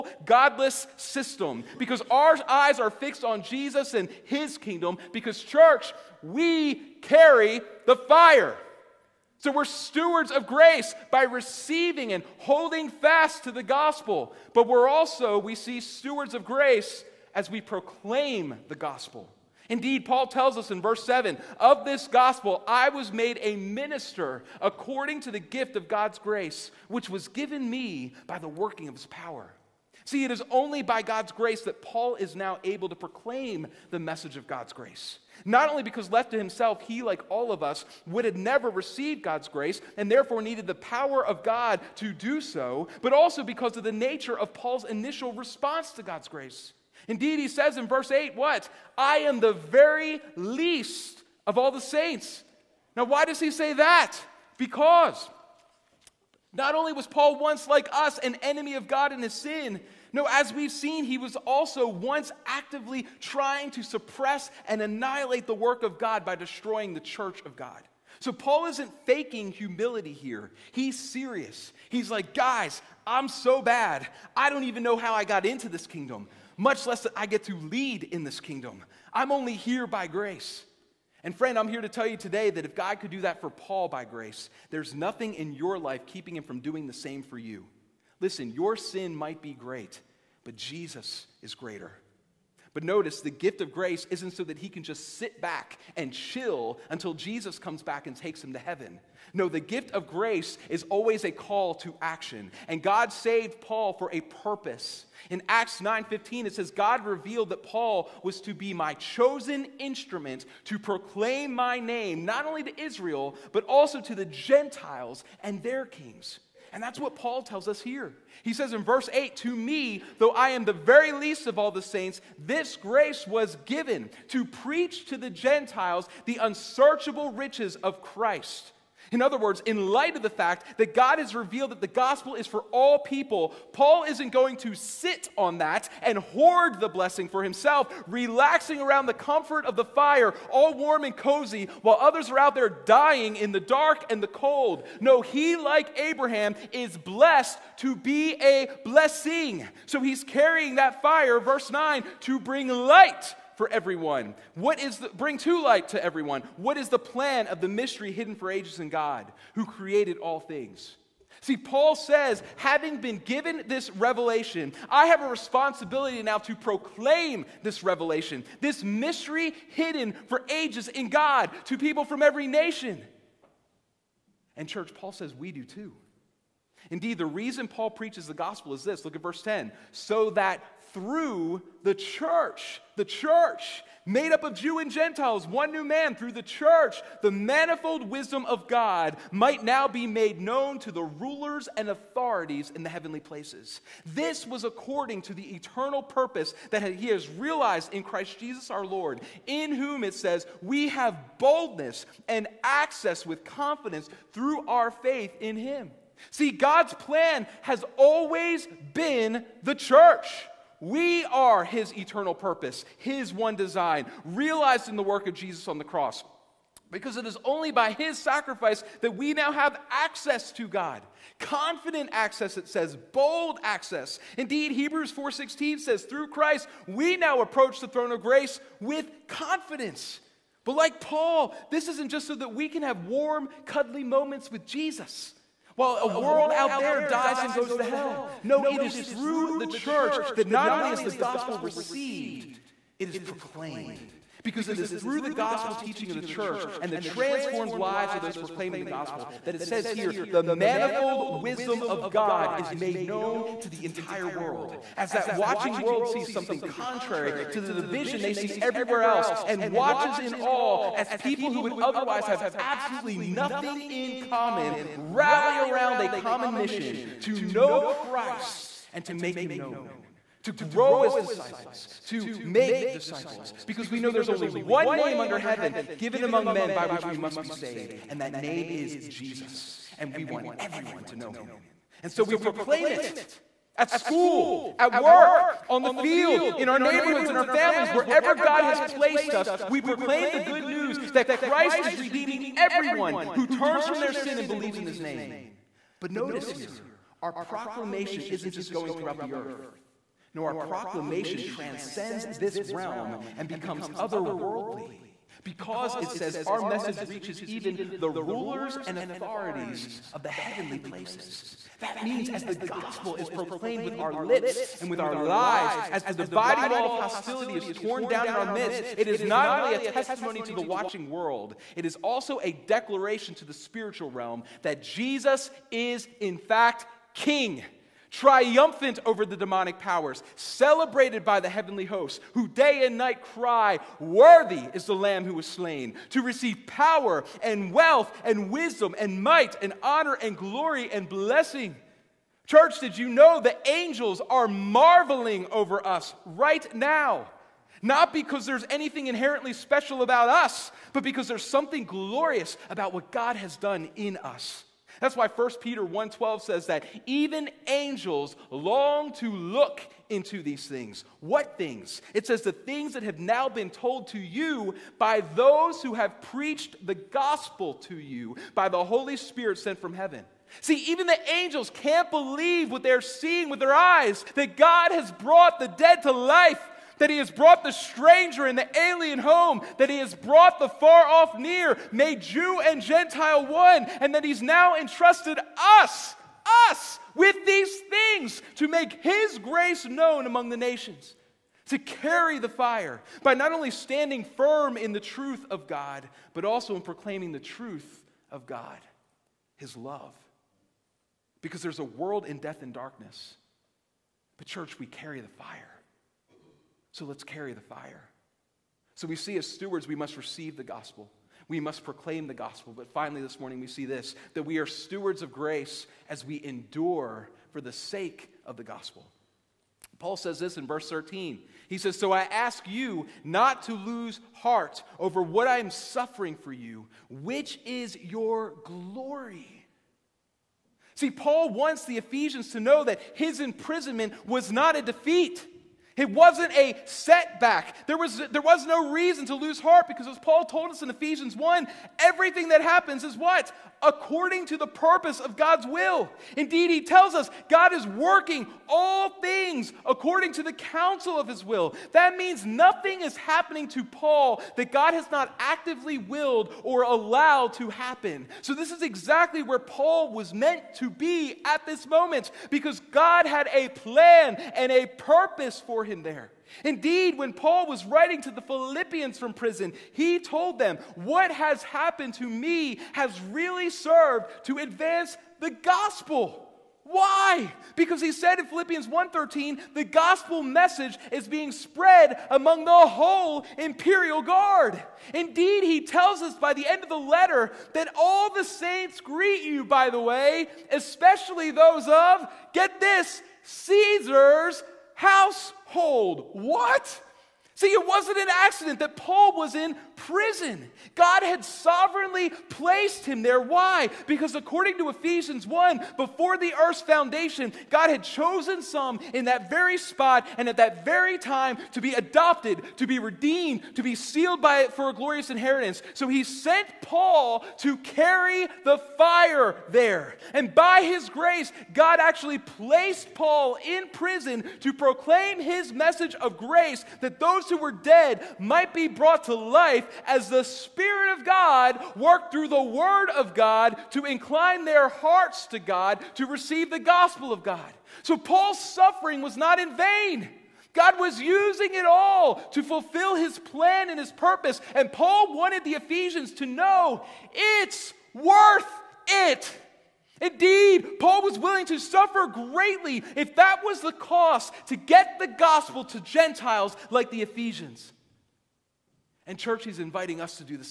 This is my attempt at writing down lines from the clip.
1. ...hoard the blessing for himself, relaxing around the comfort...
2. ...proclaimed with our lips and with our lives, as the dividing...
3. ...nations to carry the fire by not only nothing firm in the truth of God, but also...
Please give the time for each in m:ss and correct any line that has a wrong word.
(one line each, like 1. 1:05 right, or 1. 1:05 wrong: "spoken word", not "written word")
1. 2:16 right
2. 5:13 right
3. 6:30 wrong: "standing", not "nothing".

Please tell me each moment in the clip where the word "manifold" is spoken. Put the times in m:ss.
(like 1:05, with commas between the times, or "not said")
3:07, 4:10.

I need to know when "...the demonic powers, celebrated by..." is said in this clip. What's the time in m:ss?
5:29.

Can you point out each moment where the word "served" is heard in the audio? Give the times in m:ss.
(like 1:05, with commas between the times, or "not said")
7:53.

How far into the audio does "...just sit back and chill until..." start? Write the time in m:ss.
1:34.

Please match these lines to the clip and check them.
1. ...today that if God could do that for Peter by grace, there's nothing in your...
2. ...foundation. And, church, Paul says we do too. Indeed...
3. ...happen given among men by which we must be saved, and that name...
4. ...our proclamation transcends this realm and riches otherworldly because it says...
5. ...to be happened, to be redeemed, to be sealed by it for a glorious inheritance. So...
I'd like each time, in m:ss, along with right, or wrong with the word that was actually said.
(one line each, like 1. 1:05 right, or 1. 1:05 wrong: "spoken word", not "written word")
1. 1:22 wrong: "Paul", not "Peter"
2. 2:52 wrong: "nation", not "foundation"
3. 4:35 wrong: "heaven", not "happen"
4. 5:00 wrong: "becomes", not "riches"
5. 8:31 wrong: "adopted", not "happened".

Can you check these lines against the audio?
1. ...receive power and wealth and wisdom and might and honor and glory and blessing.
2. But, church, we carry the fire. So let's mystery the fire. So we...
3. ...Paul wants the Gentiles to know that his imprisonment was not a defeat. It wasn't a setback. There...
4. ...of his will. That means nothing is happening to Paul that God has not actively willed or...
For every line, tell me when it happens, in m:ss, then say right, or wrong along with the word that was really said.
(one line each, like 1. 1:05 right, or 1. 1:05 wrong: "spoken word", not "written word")
1. 5:36 right
2. 6:44 wrong: "carry", not "mystery"
3. 7:11 wrong: "Ephesians", not "Gentiles"
4. 7:31 right.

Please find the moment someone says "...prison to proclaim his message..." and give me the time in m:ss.
8:43.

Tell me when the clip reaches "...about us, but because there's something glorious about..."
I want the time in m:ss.
5:50.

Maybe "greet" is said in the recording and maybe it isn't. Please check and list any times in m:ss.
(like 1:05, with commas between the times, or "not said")
8:09.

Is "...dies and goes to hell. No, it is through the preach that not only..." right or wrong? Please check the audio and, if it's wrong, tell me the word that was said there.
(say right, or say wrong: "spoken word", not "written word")
wrong: "church", not "preach".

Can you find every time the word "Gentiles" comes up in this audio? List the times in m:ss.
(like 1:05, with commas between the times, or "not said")
1:54, 2:05, 3:04, 6:22, 9:15.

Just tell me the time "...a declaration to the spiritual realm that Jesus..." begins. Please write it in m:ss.
5:22.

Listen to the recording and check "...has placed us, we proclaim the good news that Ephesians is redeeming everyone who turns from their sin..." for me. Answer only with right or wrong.
wrong.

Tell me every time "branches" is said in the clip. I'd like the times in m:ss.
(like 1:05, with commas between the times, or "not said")
not said.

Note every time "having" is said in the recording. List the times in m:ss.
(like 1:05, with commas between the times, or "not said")
2:42.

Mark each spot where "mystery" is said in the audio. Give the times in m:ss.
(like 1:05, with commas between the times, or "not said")
2:37, 2:48.